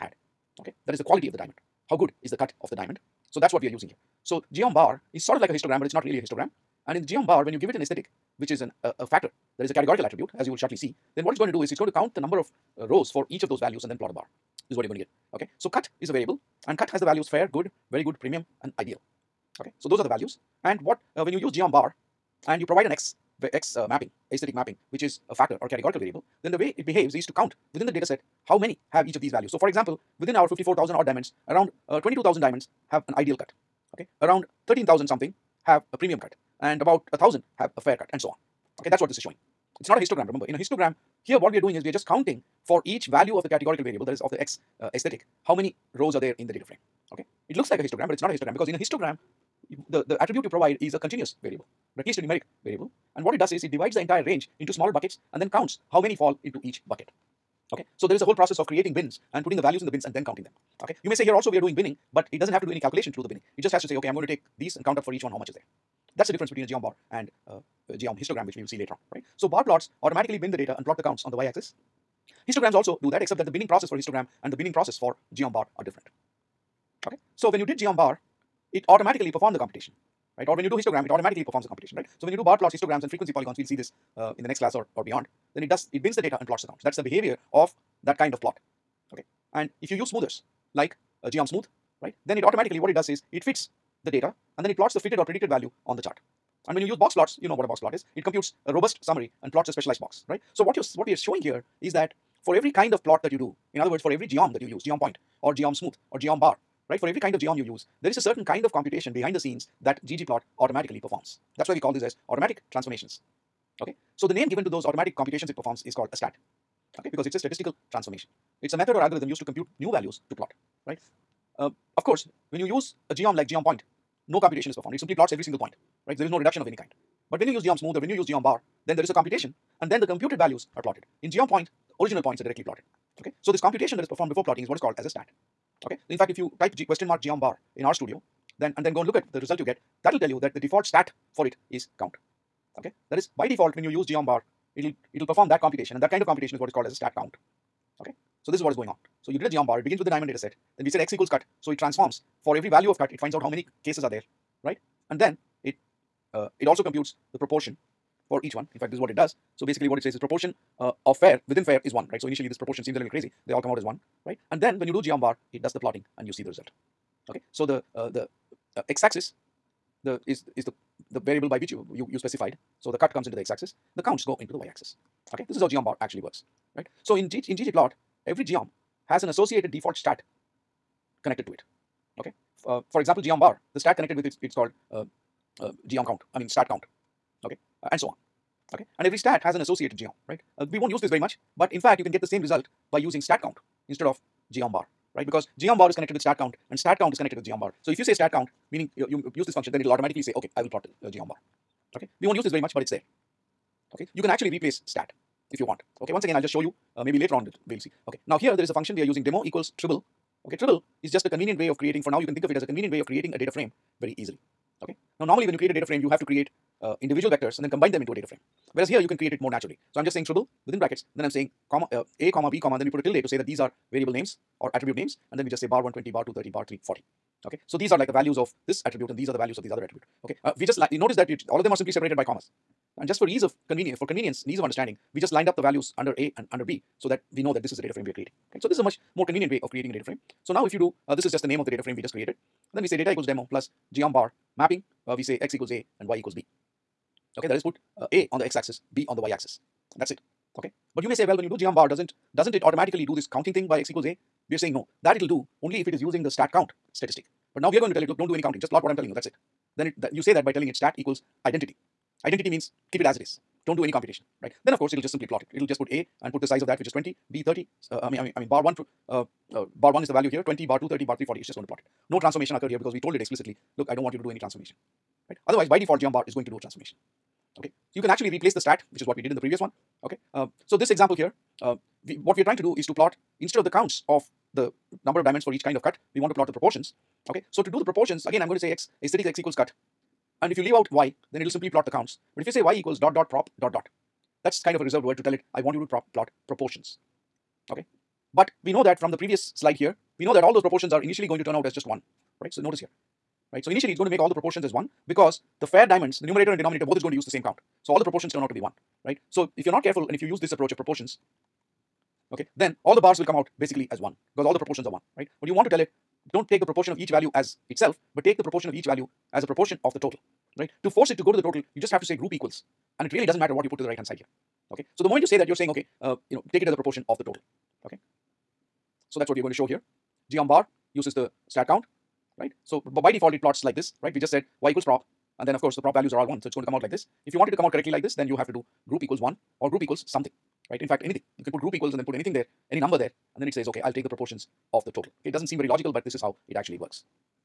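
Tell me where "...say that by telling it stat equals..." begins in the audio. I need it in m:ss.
4:20.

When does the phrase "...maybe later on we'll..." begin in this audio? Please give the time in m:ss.
3:27.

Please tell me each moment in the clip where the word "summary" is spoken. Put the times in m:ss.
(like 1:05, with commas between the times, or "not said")
1:39.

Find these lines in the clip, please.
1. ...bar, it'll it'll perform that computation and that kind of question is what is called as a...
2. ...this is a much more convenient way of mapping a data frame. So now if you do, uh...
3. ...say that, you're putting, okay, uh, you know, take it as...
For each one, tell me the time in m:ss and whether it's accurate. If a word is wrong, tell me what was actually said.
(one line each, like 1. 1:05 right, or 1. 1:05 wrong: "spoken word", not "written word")
1. 2:24 wrong: "computation", not "question"
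2. 3:58 wrong: "creating", not "mapping"
3. 5:25 wrong: "saying", not "putting".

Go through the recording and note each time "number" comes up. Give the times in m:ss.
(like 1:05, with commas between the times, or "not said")
0:12, 4:45, 5:42.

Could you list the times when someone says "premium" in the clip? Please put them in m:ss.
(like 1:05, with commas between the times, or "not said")
0:18, 0:35.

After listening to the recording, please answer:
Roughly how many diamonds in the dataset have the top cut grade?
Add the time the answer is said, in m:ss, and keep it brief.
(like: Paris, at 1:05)
22,000, at 0:31.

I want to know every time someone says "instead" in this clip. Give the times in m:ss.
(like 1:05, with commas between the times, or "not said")
3:13, 4:43.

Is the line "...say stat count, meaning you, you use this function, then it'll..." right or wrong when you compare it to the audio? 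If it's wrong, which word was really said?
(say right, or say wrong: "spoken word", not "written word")
right.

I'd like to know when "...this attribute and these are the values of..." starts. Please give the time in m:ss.
3:48.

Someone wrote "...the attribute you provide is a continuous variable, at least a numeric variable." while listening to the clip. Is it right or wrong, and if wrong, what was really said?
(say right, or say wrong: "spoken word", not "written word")
right.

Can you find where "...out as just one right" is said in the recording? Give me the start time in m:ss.
5:01.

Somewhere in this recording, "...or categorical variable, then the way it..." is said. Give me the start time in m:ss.
0:25.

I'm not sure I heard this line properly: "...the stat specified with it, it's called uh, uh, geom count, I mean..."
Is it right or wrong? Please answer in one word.
wrong.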